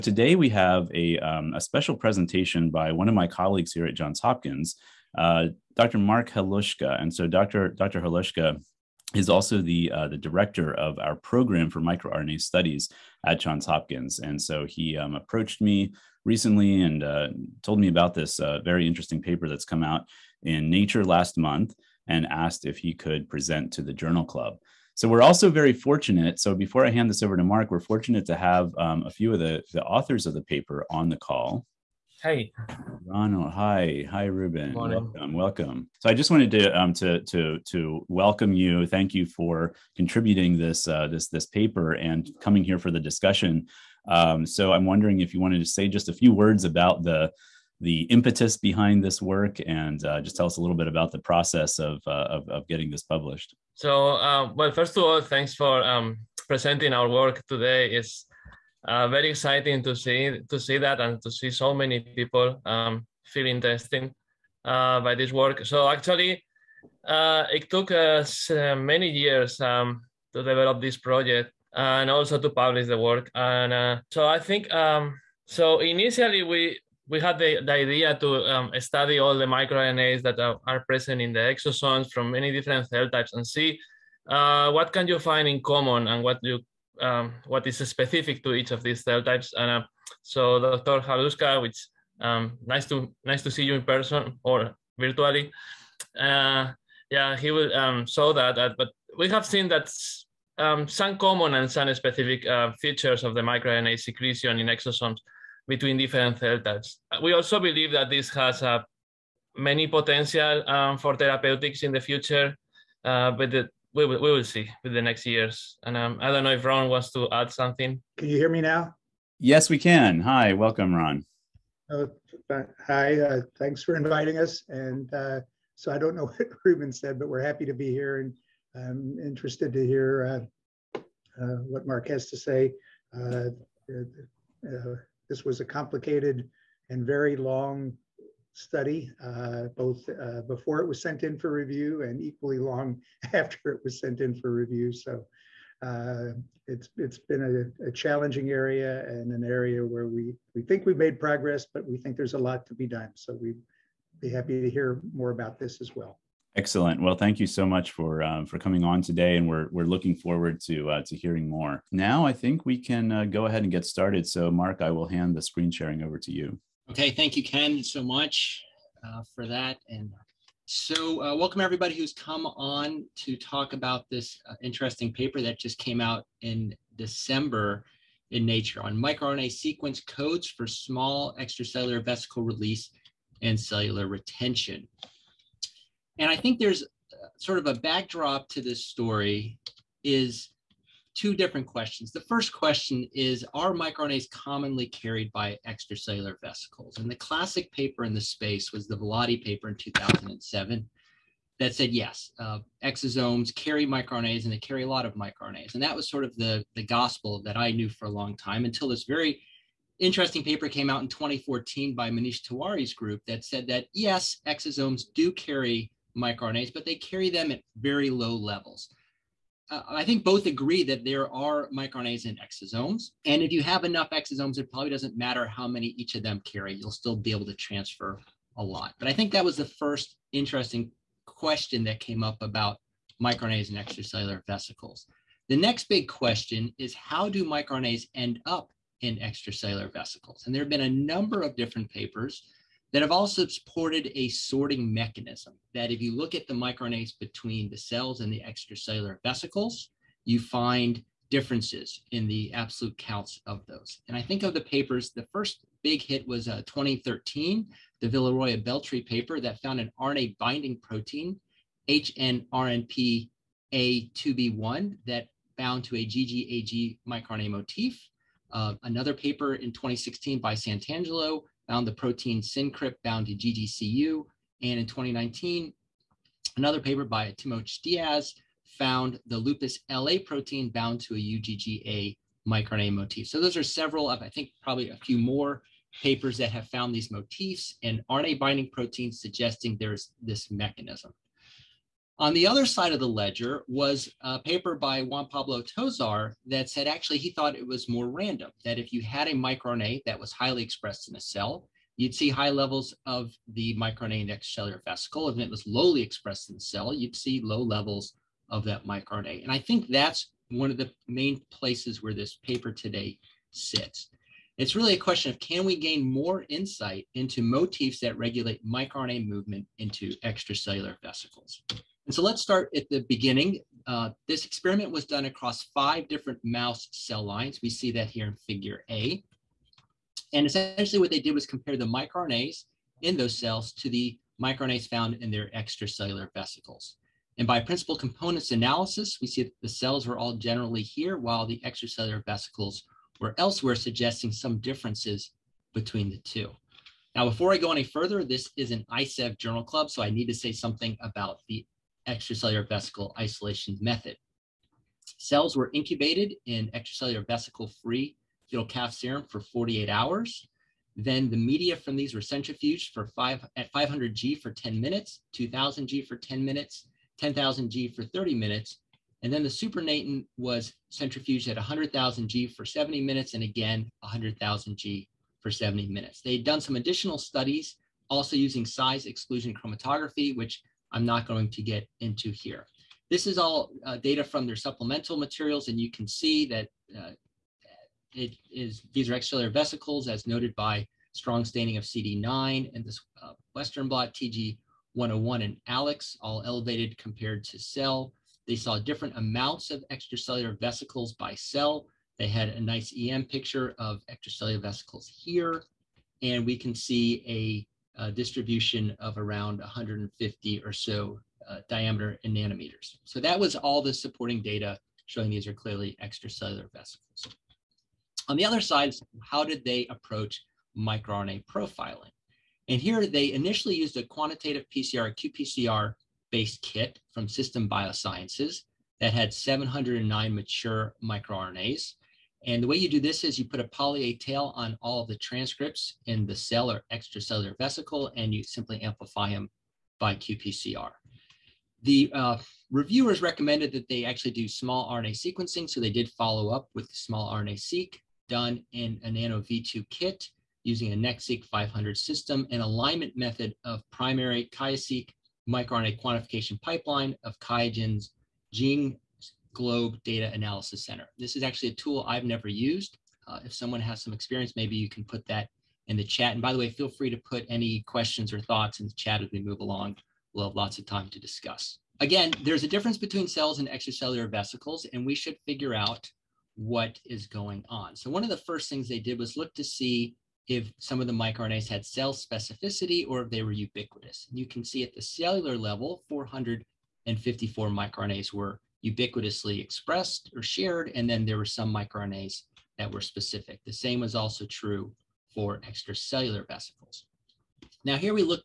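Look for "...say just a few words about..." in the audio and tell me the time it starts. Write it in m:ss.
0:45.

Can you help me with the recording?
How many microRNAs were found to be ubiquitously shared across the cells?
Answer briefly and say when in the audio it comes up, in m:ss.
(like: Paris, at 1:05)
454, at 8:06.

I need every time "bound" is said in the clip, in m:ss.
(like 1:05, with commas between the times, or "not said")
4:25, 4:33, 4:40.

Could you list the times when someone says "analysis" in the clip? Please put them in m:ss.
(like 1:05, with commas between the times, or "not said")
5:38, 7:40.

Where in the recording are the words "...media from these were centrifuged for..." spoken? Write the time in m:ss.
6:01.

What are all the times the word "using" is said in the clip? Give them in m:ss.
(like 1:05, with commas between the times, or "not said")
6:18, 7:30.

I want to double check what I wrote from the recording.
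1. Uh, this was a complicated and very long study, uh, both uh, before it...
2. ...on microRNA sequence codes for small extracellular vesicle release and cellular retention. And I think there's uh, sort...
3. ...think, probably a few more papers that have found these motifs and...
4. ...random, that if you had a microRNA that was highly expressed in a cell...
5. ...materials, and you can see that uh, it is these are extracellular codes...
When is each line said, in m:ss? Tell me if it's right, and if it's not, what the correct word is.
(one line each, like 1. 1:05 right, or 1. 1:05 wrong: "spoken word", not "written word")
1. 2:13 right
2. 2:58 right
3. 4:44 right
4. 4:58 right
5. 6:25 wrong: "vesicles", not "codes".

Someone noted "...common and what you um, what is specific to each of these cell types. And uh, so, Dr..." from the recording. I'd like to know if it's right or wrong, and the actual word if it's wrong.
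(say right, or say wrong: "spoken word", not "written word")
right.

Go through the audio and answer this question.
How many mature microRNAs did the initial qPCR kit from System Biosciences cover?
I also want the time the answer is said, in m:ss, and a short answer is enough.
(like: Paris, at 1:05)
709, at 7:09.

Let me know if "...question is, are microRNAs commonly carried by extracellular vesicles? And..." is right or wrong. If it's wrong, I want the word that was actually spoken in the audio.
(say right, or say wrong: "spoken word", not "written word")
right.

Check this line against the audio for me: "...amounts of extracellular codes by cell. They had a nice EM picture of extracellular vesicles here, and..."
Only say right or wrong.
wrong.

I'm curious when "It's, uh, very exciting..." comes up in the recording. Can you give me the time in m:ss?
0:57.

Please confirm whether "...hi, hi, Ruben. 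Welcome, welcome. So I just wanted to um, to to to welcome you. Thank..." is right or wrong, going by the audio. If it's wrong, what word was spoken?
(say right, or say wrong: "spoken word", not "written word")
right.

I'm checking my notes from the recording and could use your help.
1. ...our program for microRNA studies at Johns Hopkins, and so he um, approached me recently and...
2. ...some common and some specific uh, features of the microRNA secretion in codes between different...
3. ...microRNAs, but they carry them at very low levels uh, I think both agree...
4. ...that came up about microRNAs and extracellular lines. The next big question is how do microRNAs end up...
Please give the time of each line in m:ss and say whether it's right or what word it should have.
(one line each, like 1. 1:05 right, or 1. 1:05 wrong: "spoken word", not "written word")
1. 0:10 right
2. 1:40 wrong: "exosomes", not "codes"
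3. 3:36 right
4. 3:51 wrong: "vesicles", not "lines".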